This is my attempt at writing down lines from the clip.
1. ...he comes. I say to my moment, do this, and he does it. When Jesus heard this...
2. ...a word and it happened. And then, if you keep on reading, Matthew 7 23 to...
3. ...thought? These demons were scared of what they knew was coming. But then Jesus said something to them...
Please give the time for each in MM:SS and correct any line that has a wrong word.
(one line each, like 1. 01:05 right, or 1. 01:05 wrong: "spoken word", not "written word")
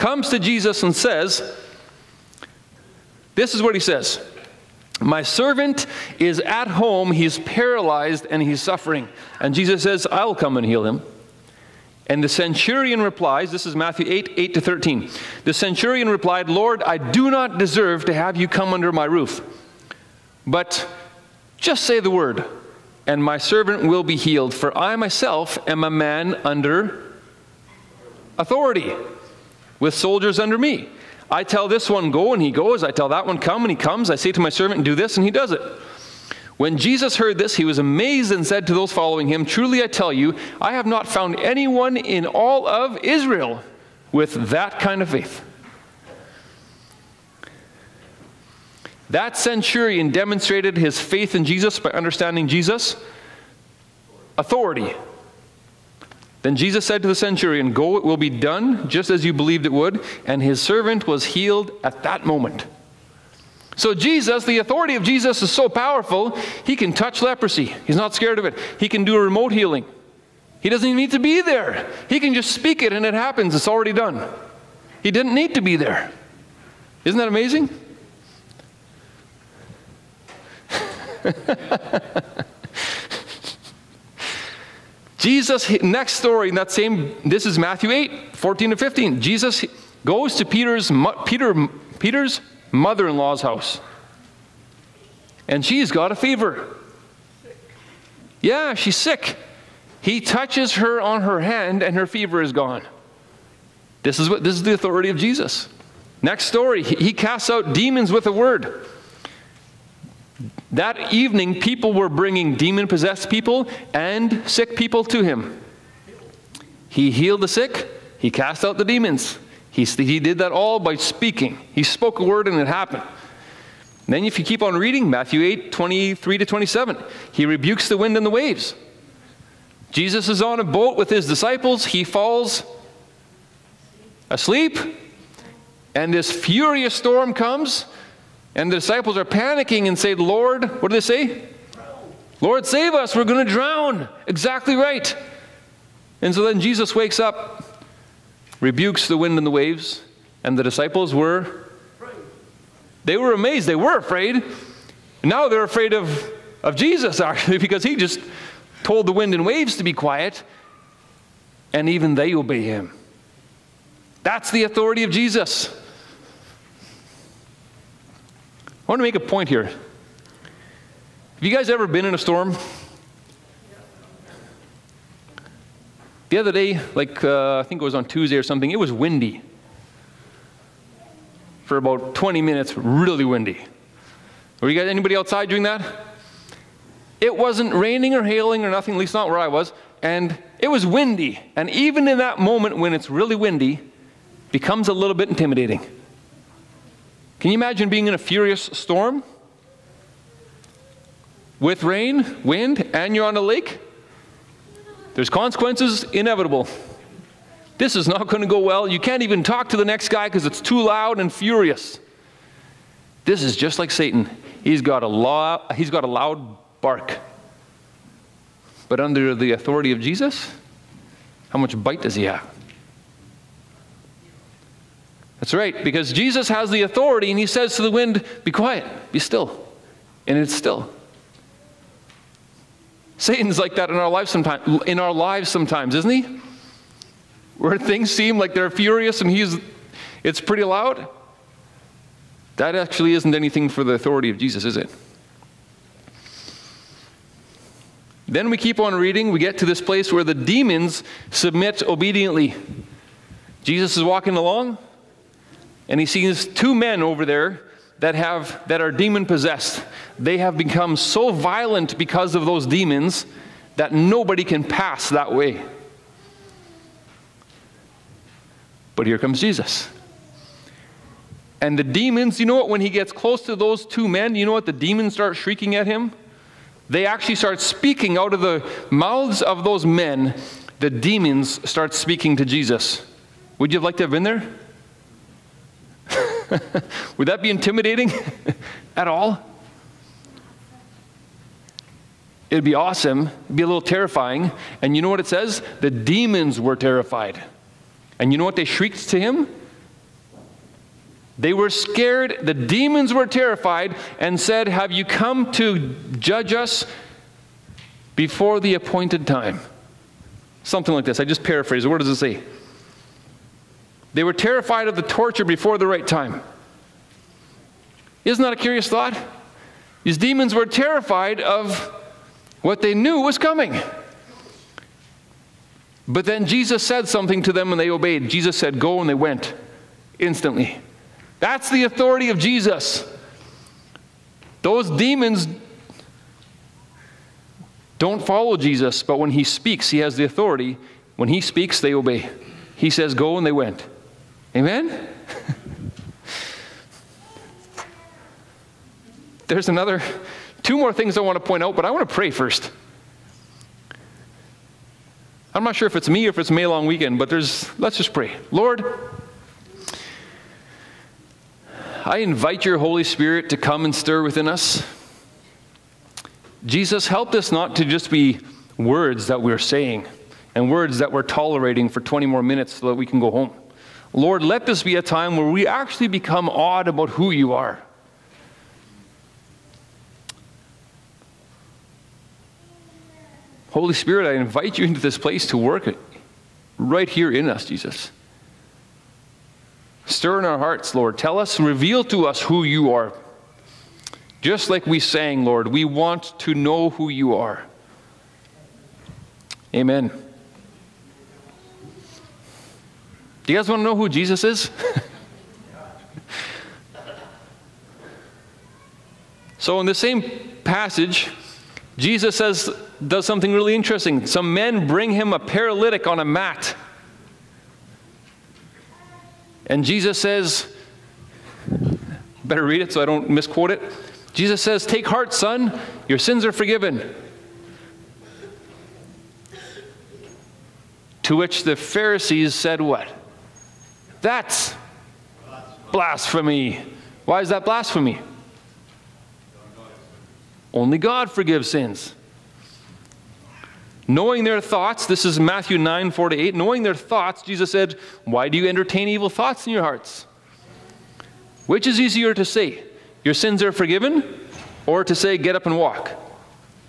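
1. 00:33 wrong: "servant", not "moment"
2. 02:02 wrong: "8", not "7"
3. 05:18 wrong: "terrified", not "scared".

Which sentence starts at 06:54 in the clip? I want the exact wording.
Some men bring him a paralytic on a mat.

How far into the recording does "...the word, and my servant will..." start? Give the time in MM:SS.
00:22.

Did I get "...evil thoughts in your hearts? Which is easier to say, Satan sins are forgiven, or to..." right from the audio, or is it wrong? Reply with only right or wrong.
wrong.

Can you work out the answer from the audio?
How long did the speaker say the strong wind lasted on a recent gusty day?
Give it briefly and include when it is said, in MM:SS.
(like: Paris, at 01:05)
20 minutes, at 03:02.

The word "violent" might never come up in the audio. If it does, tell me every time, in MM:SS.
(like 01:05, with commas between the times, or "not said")
04:21.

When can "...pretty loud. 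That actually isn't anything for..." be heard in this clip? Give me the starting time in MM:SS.
04:00.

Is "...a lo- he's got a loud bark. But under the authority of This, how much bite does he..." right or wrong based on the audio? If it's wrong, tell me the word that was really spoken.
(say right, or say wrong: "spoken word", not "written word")
wrong: "Jesus", not "This".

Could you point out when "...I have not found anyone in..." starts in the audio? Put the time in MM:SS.
00:40.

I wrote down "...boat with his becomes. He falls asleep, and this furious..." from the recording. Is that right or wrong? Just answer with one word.
wrong.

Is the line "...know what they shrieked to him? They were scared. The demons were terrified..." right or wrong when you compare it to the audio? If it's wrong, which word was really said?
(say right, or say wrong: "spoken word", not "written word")
right.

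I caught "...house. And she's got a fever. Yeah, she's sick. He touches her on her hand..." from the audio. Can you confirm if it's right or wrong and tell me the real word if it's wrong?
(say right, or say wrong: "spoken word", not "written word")
right.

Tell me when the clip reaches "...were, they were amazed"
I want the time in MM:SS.
02:31.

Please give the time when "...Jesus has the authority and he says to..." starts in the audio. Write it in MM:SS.
03:46.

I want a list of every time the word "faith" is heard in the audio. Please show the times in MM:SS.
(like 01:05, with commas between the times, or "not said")
00:45, 00:51.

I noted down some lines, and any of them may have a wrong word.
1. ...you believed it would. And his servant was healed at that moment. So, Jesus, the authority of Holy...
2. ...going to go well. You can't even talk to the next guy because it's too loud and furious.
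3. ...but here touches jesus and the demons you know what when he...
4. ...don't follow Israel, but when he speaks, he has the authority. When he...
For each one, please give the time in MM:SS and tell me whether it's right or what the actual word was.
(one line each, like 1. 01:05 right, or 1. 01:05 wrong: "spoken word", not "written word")
1. 00:59 wrong: "Jesus", not "Holy"
2. 03:28 right
3. 04:28 wrong: "comes", not "touches"
4. 05:37 wrong: "Jesus", not "Israel".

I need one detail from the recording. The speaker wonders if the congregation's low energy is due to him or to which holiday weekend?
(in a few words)
May long weekend.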